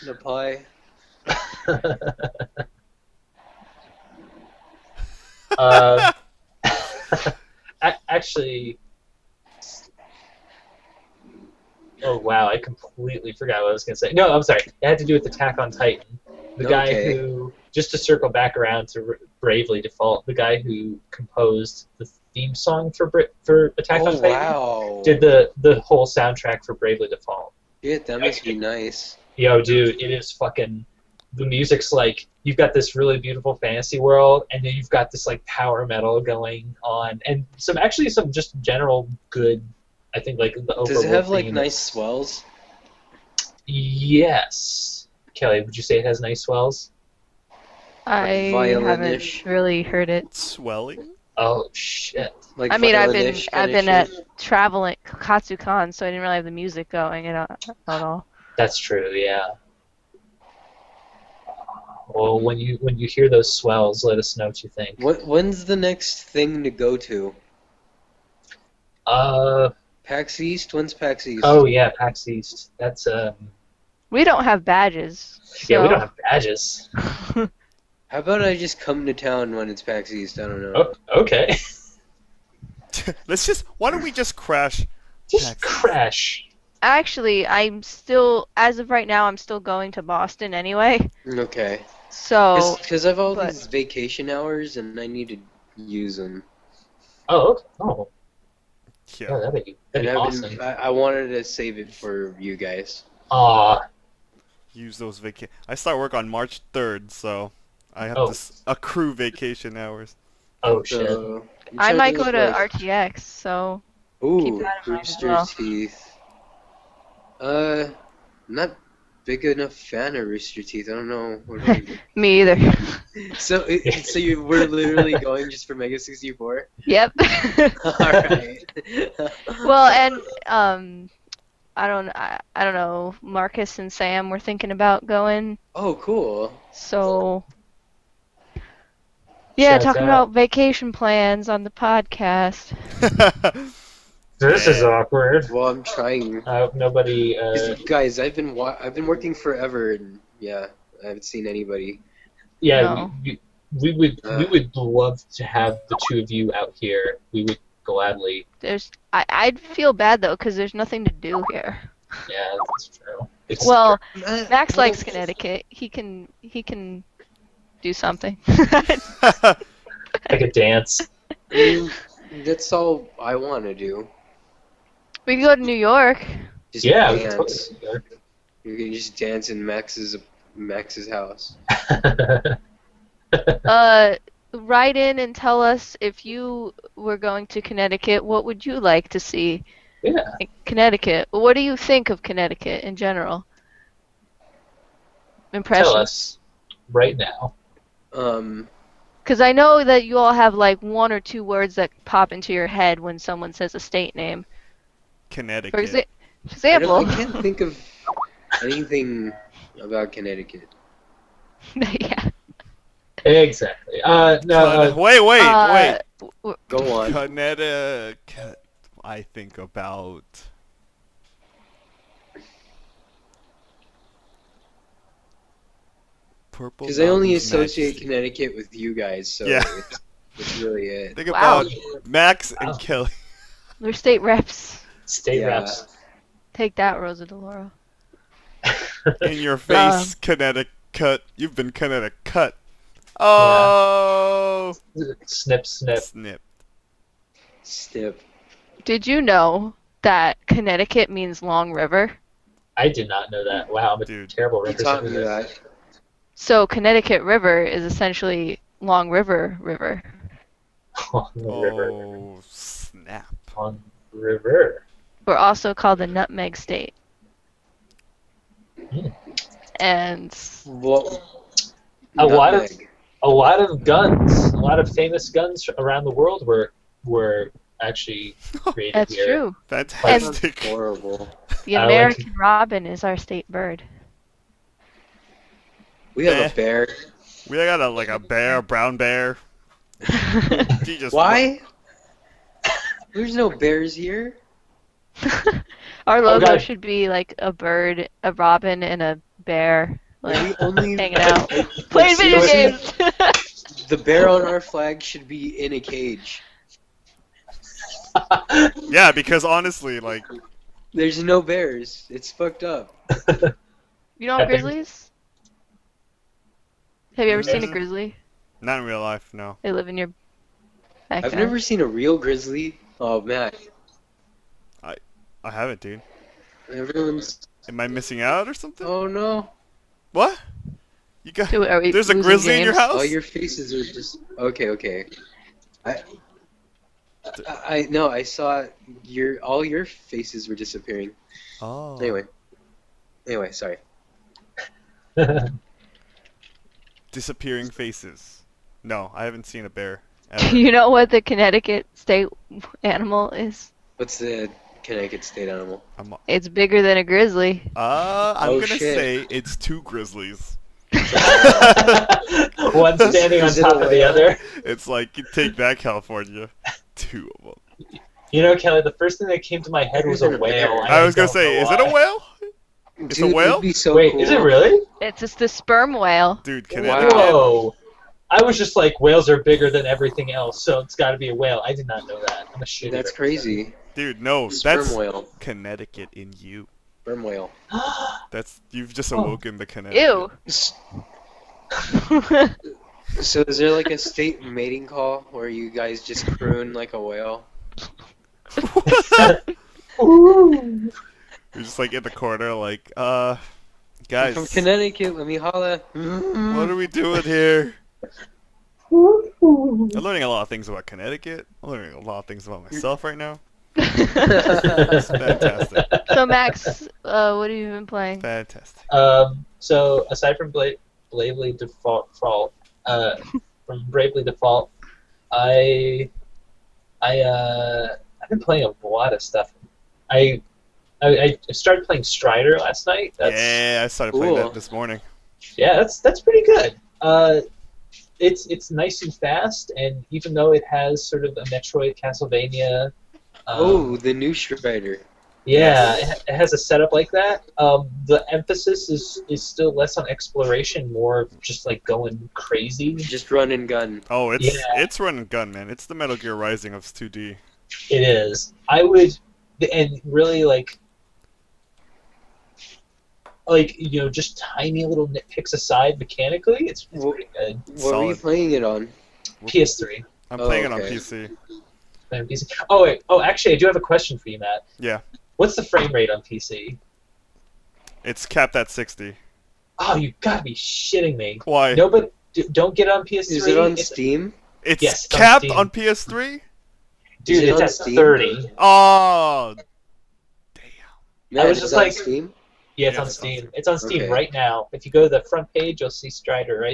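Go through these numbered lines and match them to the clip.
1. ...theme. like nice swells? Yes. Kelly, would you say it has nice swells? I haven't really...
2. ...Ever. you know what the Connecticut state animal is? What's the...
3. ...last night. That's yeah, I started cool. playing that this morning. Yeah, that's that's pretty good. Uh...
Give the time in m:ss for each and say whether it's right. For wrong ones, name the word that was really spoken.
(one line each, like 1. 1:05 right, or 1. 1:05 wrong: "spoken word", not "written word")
1. 0:41 right
2. 5:50 right
3. 7:12 right.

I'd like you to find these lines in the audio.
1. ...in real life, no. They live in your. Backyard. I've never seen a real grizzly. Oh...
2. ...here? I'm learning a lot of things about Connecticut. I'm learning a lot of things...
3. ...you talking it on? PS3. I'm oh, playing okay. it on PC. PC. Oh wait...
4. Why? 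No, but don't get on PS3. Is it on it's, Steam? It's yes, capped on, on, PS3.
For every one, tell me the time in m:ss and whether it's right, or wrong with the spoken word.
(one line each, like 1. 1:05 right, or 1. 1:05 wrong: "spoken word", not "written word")
1. 5:18 right
2. 6:47 right
3. 7:48 wrong: "playing", not "talking"
4. 8:01 right.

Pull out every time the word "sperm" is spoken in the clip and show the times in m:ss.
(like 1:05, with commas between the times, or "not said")
6:15, 6:27.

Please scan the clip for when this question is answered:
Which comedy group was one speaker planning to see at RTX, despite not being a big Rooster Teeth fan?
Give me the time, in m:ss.
2:05.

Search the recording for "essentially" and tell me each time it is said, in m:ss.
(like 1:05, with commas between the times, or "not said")
4:17.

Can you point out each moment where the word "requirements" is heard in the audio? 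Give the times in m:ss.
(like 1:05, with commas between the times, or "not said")
not said.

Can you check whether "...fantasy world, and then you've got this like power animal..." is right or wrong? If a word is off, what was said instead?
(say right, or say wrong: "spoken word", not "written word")
wrong: "metal", not "animal".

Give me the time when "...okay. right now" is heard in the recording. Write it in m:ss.
8:14.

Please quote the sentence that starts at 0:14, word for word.
It had to do with Attack on Titan.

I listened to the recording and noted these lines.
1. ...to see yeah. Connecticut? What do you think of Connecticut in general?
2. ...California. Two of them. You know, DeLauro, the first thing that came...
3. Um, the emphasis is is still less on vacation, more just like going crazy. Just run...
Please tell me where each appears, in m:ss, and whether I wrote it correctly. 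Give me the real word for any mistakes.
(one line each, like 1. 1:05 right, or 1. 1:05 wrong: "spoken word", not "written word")
1. 3:09 right
2. 6:05 wrong: "Kelly", not "DeLauro"
3. 7:27 wrong: "exploration", not "vacation".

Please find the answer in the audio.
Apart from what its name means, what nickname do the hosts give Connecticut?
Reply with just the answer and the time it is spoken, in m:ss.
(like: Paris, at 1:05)
Nutmeg State, at 4:26.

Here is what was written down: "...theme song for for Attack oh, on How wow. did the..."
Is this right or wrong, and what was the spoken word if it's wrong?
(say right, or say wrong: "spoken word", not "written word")
wrong: "Titan", not "How".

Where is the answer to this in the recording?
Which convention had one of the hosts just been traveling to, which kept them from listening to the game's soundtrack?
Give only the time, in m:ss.
0:55.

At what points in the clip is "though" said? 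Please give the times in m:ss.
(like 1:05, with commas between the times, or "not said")
2:40, 7:20.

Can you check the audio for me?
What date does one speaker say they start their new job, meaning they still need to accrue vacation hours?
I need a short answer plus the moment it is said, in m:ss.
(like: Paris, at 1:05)
March 3, at 1:46.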